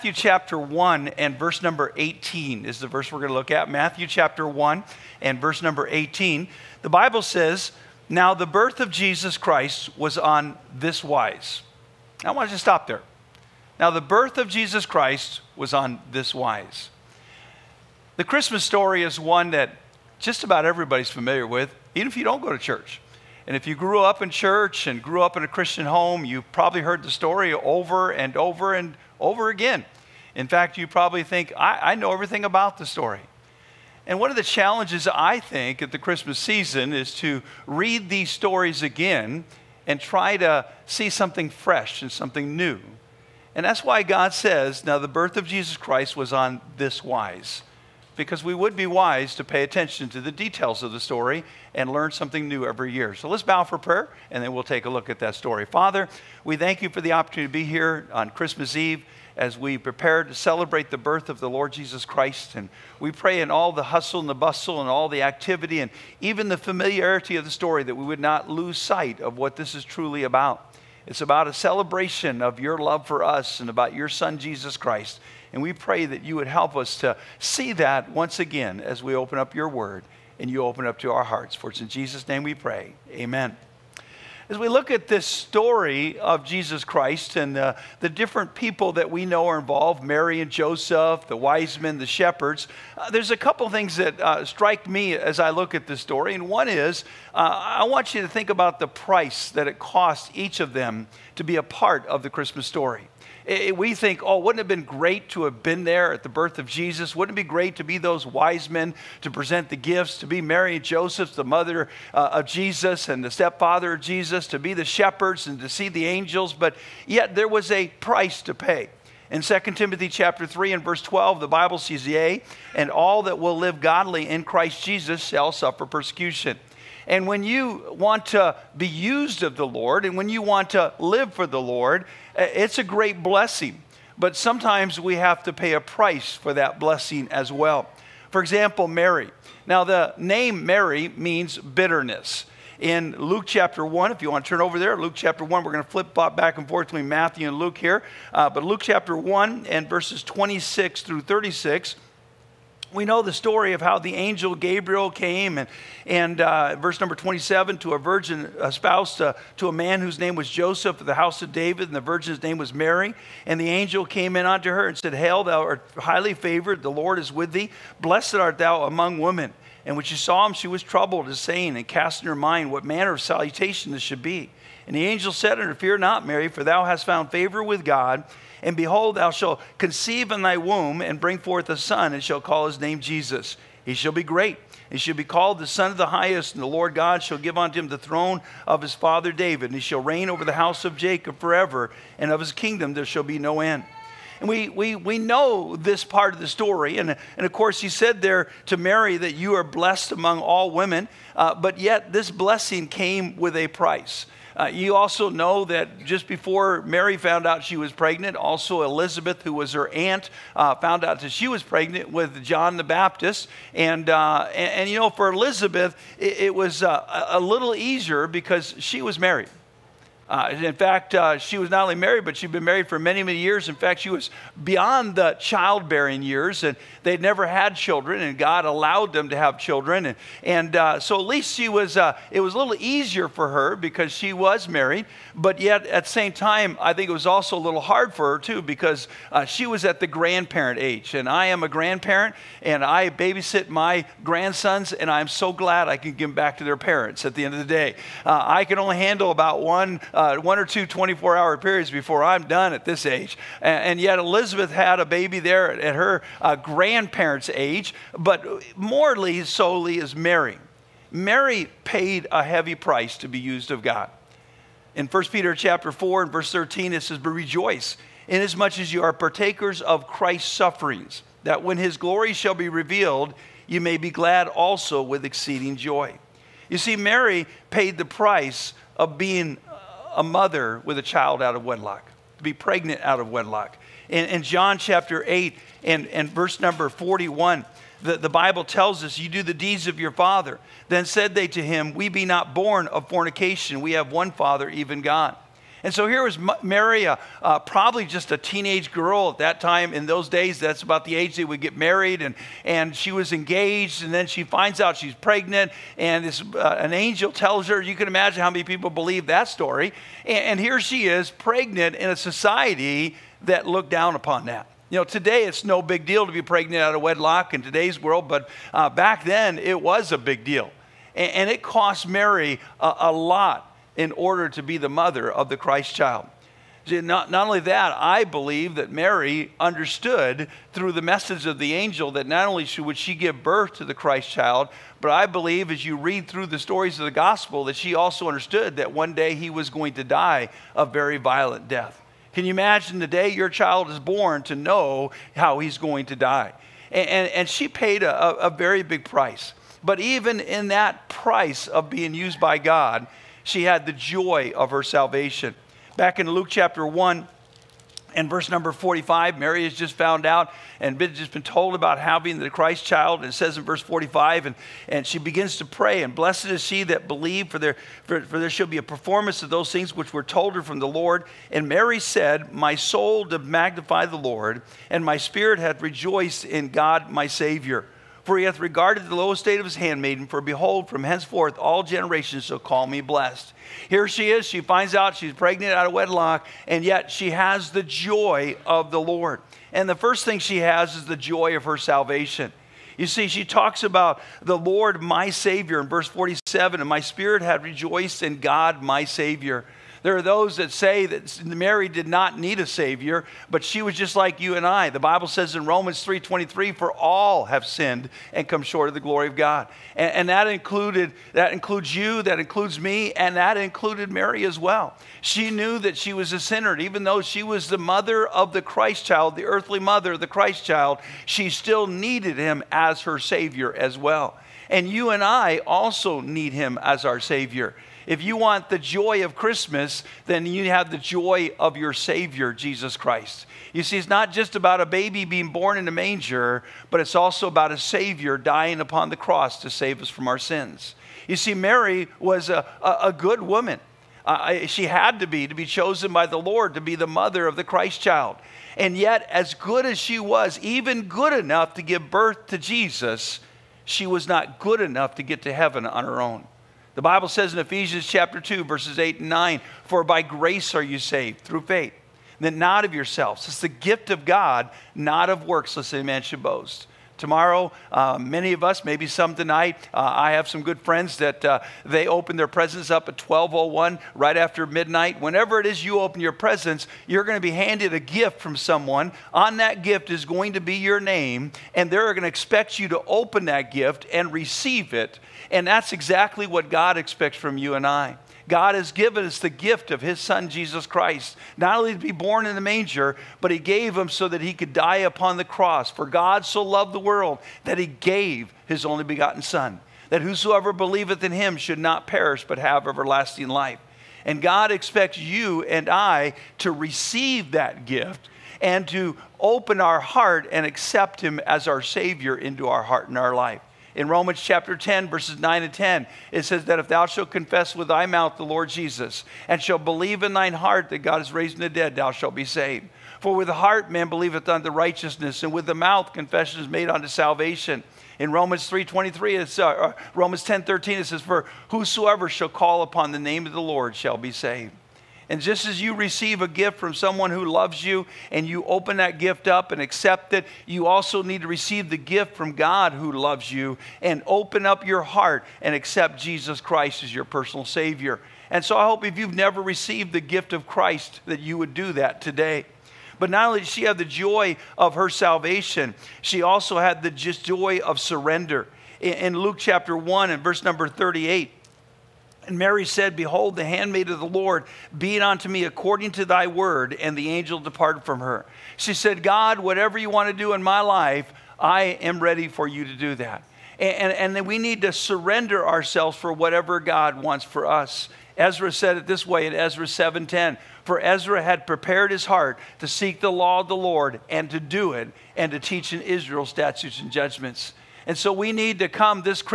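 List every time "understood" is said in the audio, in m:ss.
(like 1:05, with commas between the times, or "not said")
5:29, 5:38.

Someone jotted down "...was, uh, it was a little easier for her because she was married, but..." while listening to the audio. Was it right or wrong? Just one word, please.
right.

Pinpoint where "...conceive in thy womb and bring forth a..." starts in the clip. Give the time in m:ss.
2:59.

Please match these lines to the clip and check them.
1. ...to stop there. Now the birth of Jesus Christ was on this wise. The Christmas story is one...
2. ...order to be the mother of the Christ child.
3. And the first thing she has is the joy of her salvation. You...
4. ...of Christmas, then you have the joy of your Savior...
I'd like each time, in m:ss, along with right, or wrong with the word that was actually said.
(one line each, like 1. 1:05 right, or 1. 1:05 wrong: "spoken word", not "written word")
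1. 0:12 right
2. 5:24 right
3. 6:29 right
4. 7:09 right.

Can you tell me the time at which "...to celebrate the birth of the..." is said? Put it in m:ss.
1:00.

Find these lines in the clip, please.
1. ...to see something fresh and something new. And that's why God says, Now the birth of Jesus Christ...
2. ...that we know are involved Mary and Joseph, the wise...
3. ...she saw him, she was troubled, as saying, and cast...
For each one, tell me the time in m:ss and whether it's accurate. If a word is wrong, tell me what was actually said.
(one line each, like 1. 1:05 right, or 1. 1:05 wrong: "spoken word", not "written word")
1. 0:40 right
2. 1:28 right
3. 2:50 right.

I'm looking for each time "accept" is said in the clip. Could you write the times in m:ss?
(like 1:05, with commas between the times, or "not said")
8:30, 8:59, 9:05.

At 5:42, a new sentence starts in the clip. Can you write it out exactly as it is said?
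Can you imagine the day your child is born to know how he's going to die?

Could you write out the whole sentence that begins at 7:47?
Uh, many of us, maybe some tonight.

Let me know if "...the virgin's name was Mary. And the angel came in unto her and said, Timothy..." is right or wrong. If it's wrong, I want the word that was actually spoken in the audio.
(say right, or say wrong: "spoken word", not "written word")
wrong: "Hail", not "Timothy".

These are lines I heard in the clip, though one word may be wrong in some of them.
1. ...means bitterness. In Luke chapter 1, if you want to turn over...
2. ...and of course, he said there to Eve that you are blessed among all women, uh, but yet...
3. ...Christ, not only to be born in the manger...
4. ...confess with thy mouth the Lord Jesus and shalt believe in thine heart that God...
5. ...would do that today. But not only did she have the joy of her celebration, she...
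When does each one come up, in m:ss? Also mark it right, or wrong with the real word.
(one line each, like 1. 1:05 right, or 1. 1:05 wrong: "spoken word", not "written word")
1. 2:21 right
2. 3:17 wrong: "Mary", not "Eve"
3. 8:10 right
4. 8:37 right
5. 9:11 wrong: "salvation", not "celebration".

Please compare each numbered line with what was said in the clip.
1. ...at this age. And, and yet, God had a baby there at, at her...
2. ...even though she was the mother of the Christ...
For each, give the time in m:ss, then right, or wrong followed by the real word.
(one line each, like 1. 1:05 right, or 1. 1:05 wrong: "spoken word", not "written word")
1. 4:12 wrong: "Elizabeth", not "God"
2. 6:56 right.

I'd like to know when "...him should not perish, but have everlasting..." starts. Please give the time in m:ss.
8:21.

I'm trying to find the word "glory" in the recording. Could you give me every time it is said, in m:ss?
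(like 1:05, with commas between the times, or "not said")
4:31, 6:49.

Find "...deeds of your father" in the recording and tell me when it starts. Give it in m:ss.
4:49.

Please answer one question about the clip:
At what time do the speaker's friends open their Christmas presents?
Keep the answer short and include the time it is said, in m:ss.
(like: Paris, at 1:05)
12:01, at 7:53.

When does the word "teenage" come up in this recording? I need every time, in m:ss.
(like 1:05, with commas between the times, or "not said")
4:58.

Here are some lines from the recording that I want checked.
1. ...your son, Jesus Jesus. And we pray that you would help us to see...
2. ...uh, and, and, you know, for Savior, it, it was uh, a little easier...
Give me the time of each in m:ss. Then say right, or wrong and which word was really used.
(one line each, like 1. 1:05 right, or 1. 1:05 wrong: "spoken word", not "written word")
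1. 1:13 wrong: "Christ", not "Jesus"
2. 3:34 wrong: "Elizabeth", not "Savior".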